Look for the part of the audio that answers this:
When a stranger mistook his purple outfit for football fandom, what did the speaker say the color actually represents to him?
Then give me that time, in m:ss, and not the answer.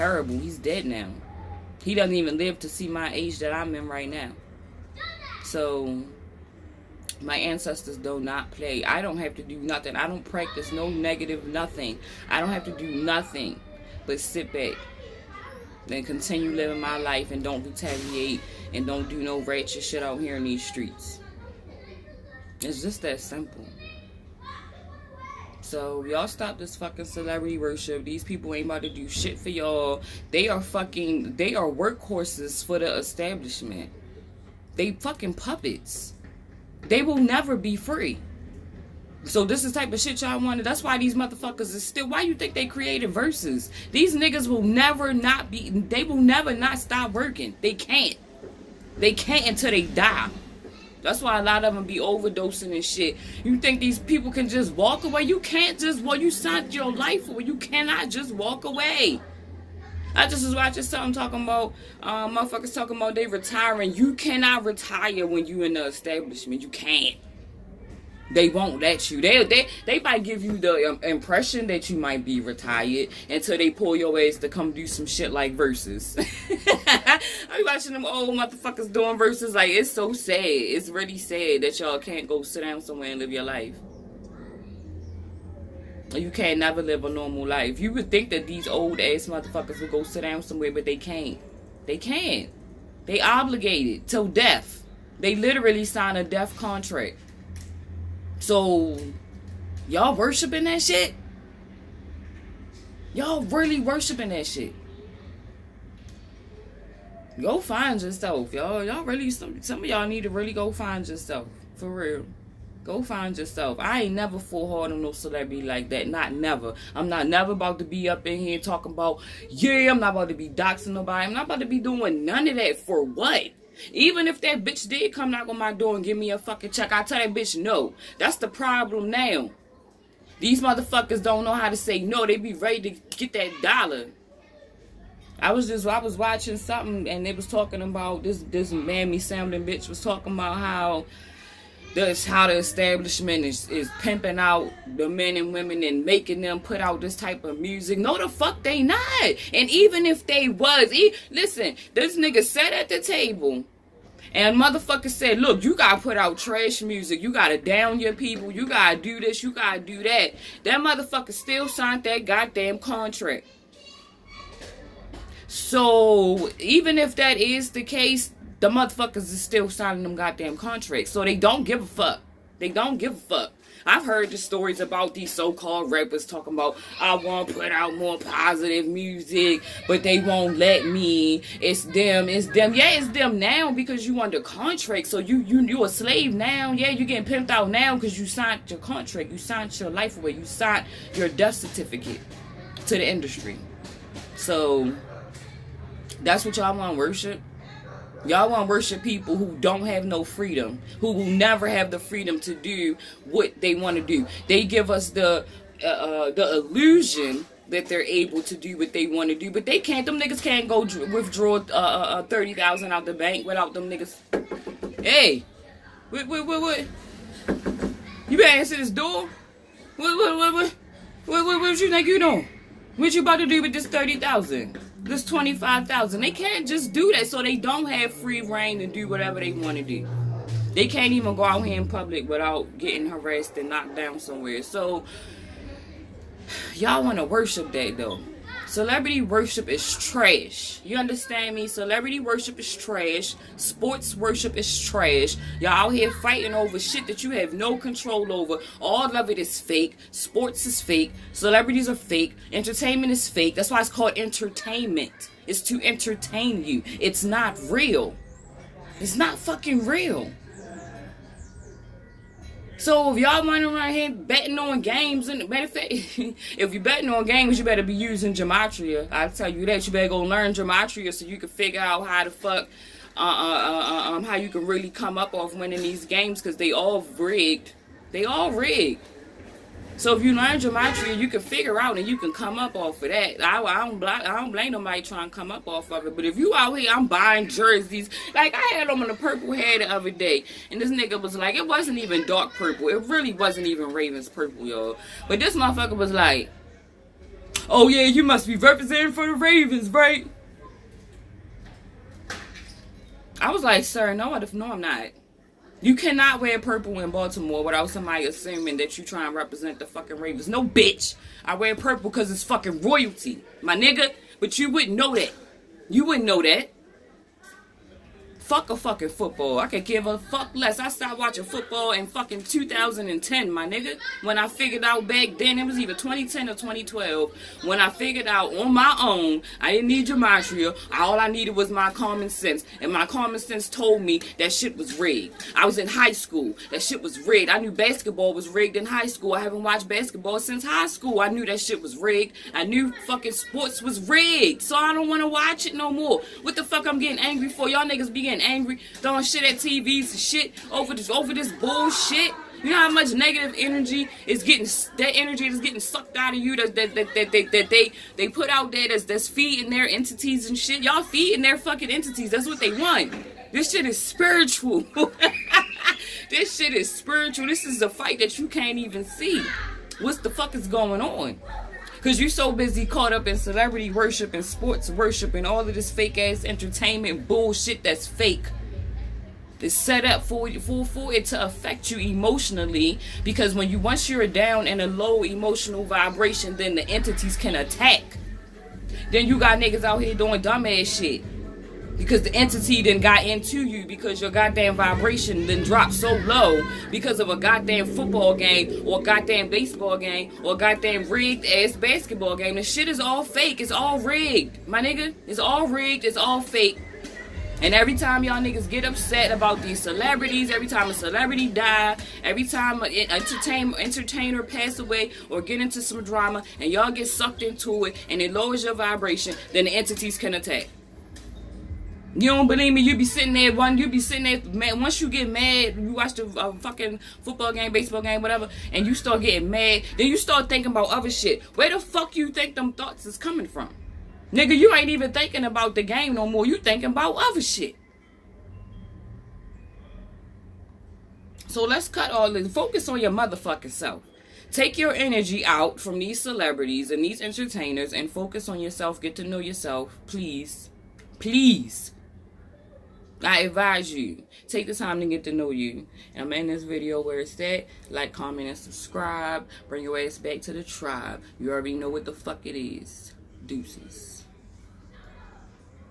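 5:12.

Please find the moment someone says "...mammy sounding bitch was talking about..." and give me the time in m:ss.
2:18.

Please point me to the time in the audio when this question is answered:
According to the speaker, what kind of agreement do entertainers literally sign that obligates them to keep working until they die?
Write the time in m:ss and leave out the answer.
1:36.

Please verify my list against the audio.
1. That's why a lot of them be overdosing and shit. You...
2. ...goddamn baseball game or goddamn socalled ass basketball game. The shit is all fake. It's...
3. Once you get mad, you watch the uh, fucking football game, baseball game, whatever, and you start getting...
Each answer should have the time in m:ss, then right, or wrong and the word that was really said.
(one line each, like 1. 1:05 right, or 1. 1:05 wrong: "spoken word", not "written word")
1. 0:51 right
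2. 6:39 wrong: "rigged", not "socalled"
3. 7:04 right.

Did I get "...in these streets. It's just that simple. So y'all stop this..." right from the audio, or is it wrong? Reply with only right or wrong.
right.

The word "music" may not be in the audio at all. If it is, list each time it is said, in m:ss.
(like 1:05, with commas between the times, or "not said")
2:27, 2:36, 2:58.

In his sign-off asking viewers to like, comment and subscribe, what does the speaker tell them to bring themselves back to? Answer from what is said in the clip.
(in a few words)
the tribe.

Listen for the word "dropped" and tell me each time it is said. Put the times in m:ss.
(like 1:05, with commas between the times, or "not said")
6:35.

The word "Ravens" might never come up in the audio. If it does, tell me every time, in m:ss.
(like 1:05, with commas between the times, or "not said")
4:53, 4:59, 5:10.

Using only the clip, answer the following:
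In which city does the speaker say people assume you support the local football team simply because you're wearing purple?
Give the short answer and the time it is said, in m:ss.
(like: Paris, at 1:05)
Baltimore, at 5:07.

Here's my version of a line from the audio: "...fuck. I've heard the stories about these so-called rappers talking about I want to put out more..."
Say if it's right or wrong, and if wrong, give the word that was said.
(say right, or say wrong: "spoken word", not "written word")
right.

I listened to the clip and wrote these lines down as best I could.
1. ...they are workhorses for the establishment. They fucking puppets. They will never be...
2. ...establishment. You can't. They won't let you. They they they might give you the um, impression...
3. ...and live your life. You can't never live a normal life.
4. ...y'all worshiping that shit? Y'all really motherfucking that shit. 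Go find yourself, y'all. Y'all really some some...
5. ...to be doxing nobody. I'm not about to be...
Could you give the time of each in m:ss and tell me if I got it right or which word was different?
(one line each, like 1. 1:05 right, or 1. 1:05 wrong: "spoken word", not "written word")
1. 0:31 right
2. 1:05 right
3. 1:23 right
4. 1:39 wrong: "worshiping", not "motherfucking"
5. 2:00 right.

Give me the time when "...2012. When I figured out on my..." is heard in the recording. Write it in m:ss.
5:26.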